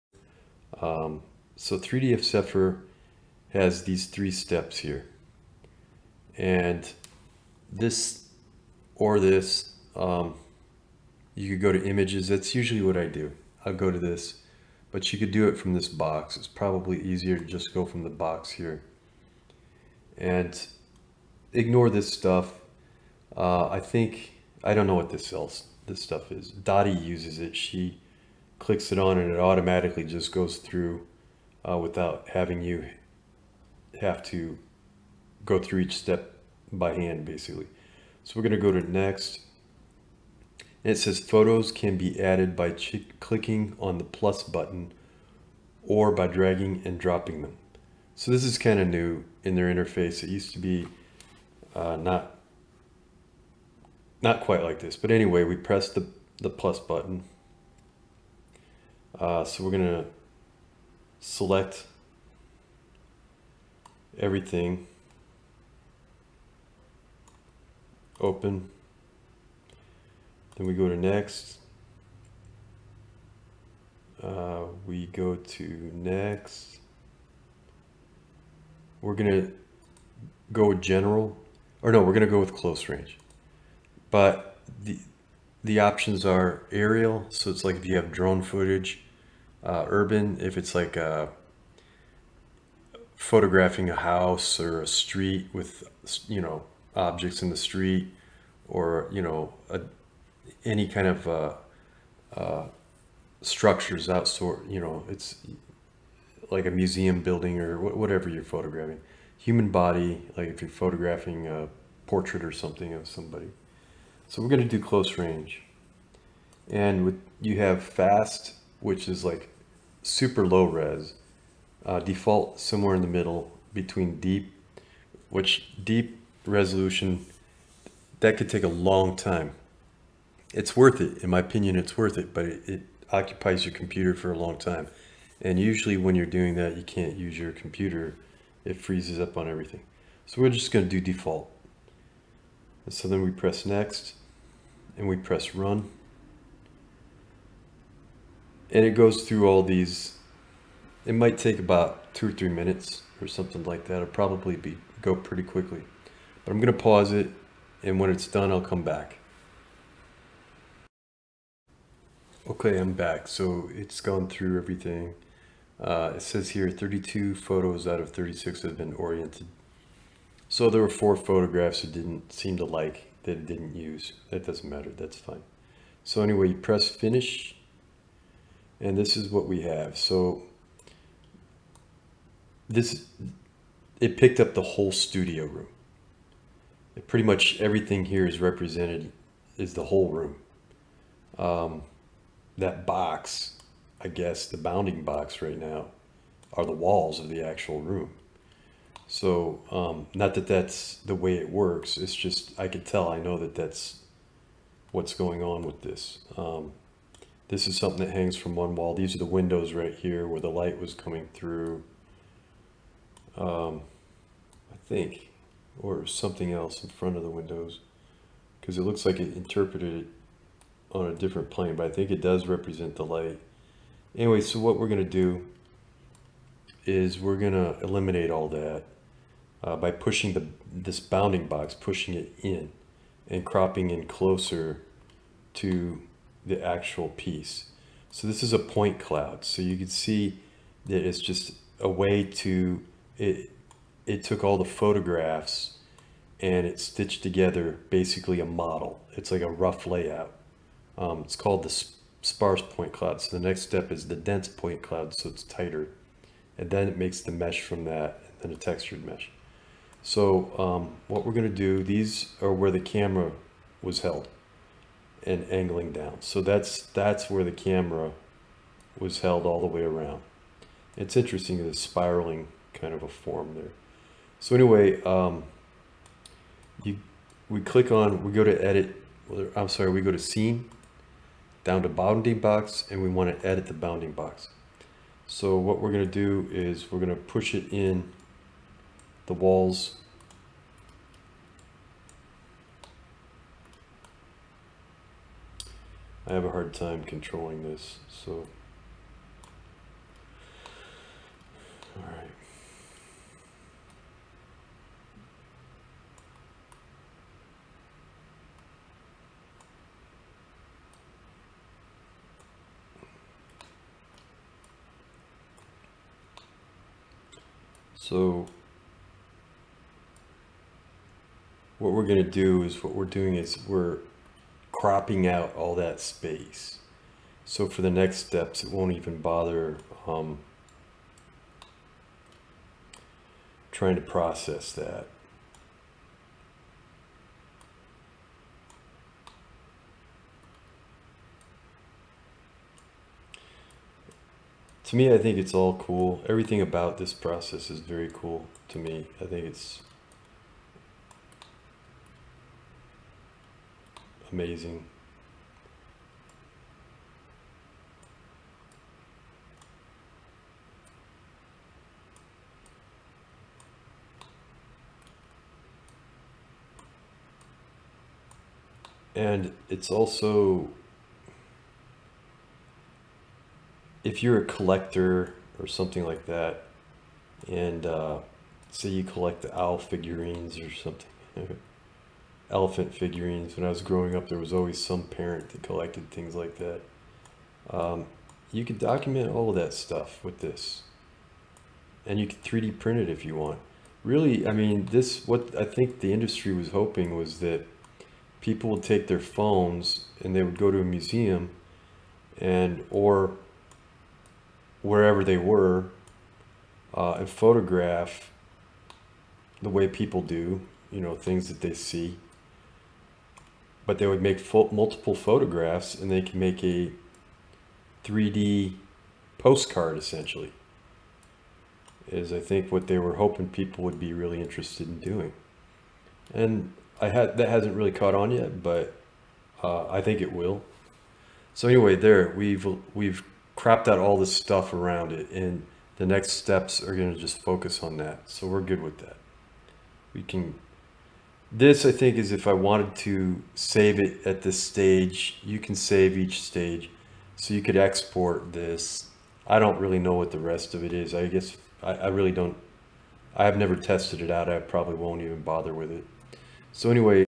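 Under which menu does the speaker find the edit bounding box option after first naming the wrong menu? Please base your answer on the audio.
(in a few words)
scene.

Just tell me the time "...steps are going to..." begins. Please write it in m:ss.
7:16.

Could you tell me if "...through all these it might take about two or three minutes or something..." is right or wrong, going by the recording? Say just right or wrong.
right.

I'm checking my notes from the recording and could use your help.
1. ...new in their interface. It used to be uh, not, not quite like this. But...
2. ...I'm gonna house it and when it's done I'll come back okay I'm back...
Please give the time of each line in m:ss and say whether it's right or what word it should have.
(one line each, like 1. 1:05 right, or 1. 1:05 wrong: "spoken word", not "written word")
1. 0:48 right
2. 2:36 wrong: "pause", not "house".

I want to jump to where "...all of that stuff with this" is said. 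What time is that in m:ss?
6:29.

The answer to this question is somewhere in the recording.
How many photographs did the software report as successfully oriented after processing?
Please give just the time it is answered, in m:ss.
2:46.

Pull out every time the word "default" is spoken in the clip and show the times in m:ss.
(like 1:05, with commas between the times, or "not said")
2:01, 2:21.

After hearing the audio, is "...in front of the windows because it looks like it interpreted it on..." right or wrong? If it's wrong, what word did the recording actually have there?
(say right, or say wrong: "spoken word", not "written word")
right.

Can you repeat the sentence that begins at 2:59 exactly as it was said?
So this, it picked up the whole studio room.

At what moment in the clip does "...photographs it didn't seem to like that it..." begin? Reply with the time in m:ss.
2:51.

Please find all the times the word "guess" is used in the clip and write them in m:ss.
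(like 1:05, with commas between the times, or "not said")
3:14, 7:31.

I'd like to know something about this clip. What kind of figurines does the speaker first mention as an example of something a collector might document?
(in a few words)
owl figurines.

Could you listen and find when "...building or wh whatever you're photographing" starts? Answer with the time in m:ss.
1:47.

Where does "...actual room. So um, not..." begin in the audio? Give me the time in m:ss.
3:17.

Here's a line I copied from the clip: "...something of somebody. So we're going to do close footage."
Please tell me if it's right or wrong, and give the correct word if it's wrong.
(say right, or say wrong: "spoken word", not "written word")
wrong: "range", not "footage".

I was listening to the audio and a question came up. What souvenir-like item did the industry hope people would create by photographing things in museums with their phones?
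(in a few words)
3D postcard.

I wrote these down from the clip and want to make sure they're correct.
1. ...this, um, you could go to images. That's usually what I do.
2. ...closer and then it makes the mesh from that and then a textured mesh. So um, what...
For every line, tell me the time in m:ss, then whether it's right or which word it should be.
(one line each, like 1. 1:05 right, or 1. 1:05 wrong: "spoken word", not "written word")
1. 0:09 right
2. 4:15 wrong: "tighter", not "closer".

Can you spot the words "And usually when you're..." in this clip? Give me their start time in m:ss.
2:15.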